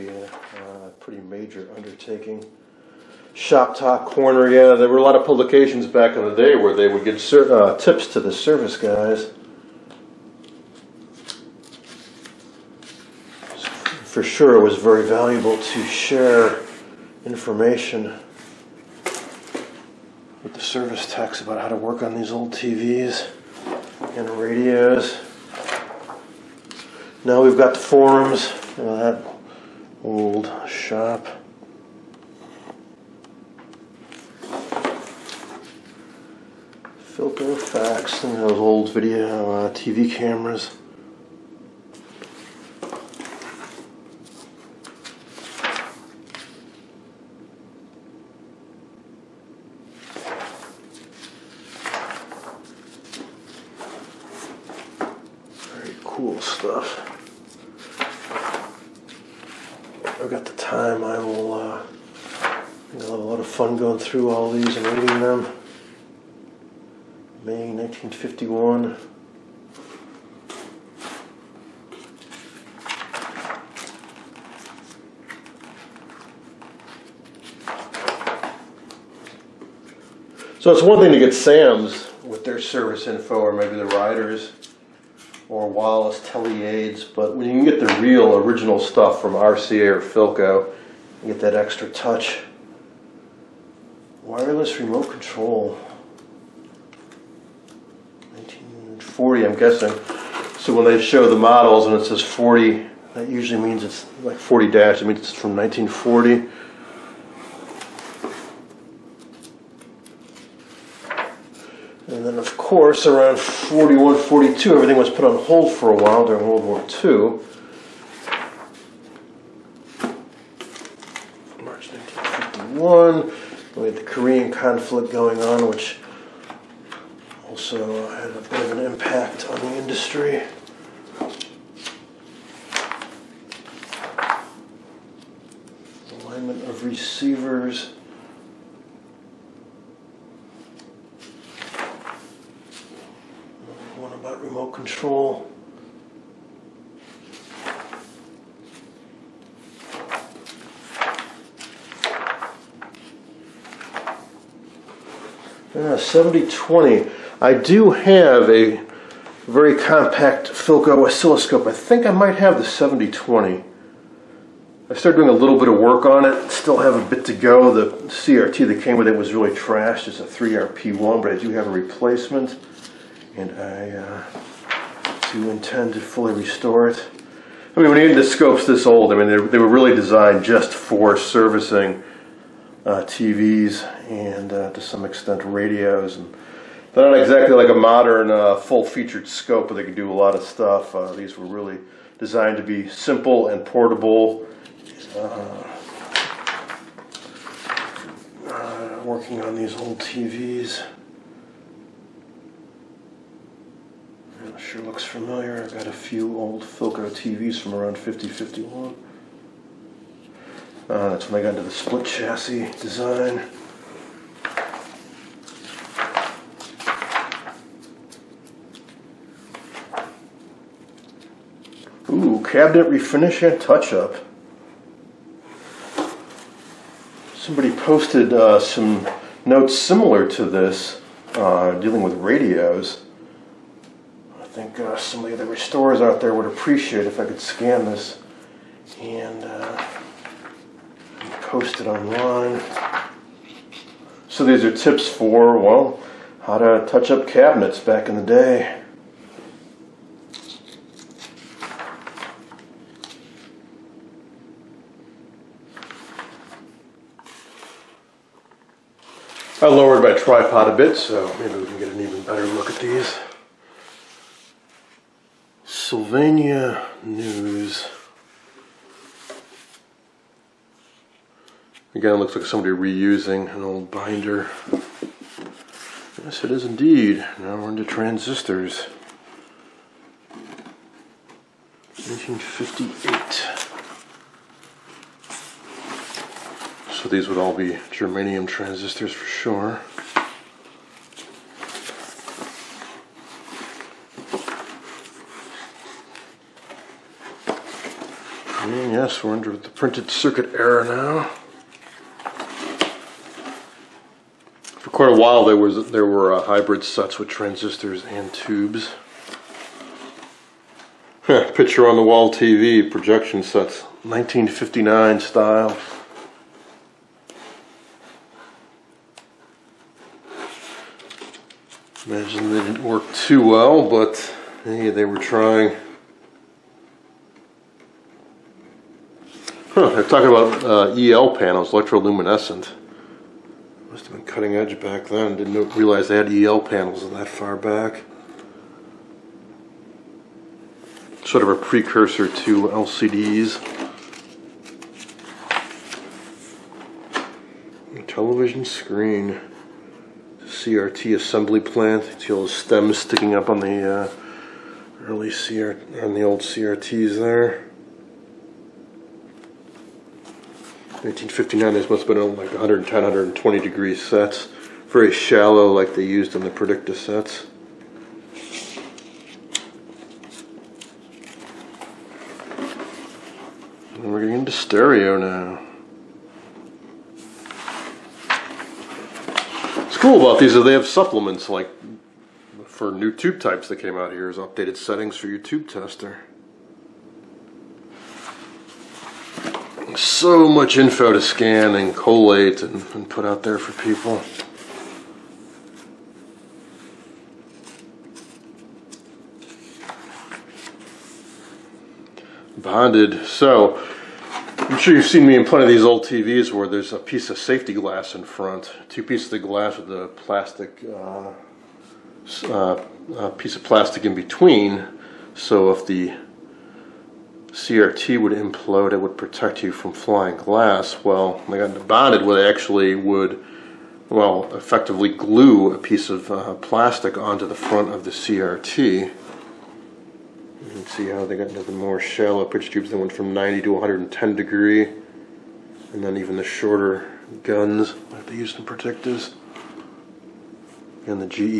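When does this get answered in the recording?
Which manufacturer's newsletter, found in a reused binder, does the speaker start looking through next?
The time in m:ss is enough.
4:25.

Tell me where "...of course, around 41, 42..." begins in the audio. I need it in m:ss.
1:52.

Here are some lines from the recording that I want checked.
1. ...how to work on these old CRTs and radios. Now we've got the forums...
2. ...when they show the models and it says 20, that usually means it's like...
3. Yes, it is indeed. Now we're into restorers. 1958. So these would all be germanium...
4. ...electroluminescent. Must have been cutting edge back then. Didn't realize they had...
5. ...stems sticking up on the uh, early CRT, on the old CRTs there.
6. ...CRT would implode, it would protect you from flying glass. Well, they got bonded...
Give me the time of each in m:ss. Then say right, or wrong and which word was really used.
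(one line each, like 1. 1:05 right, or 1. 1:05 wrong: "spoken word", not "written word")
1. 0:21 wrong: "TVs", not "CRTs"
2. 1:40 wrong: "40", not "20"
3. 4:36 wrong: "transistors", not "restorers"
4. 5:31 right
5. 5:52 right
6. 6:57 right.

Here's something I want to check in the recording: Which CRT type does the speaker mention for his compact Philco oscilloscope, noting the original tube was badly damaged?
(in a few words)
3RP1.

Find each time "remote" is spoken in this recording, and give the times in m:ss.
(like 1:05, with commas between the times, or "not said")
1:34, 2:24.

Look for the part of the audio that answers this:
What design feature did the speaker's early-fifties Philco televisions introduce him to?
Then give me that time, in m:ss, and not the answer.
3:31.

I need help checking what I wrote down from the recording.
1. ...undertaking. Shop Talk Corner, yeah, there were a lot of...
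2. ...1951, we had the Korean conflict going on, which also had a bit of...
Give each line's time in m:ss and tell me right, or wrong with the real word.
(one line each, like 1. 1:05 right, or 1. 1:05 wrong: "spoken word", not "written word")
1. 0:01 right
2. 2:01 right.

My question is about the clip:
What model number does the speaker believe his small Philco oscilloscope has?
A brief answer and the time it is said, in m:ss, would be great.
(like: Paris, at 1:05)
7020, at 2:42.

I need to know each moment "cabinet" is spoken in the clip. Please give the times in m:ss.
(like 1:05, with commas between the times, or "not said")
3:42, 4:07.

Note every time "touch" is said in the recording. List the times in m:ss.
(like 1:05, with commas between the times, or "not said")
1:31, 3:43, 4:06.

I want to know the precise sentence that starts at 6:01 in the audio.
1959, this must have been oh, like 110, 120 degree sets.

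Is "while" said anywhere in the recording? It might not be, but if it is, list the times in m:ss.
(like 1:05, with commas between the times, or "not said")
1:55, 5:05.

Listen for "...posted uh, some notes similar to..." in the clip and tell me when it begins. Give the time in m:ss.
3:47.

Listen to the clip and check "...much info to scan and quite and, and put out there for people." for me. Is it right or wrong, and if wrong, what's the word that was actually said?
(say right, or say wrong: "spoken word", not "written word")
wrong: "collate", not "quite".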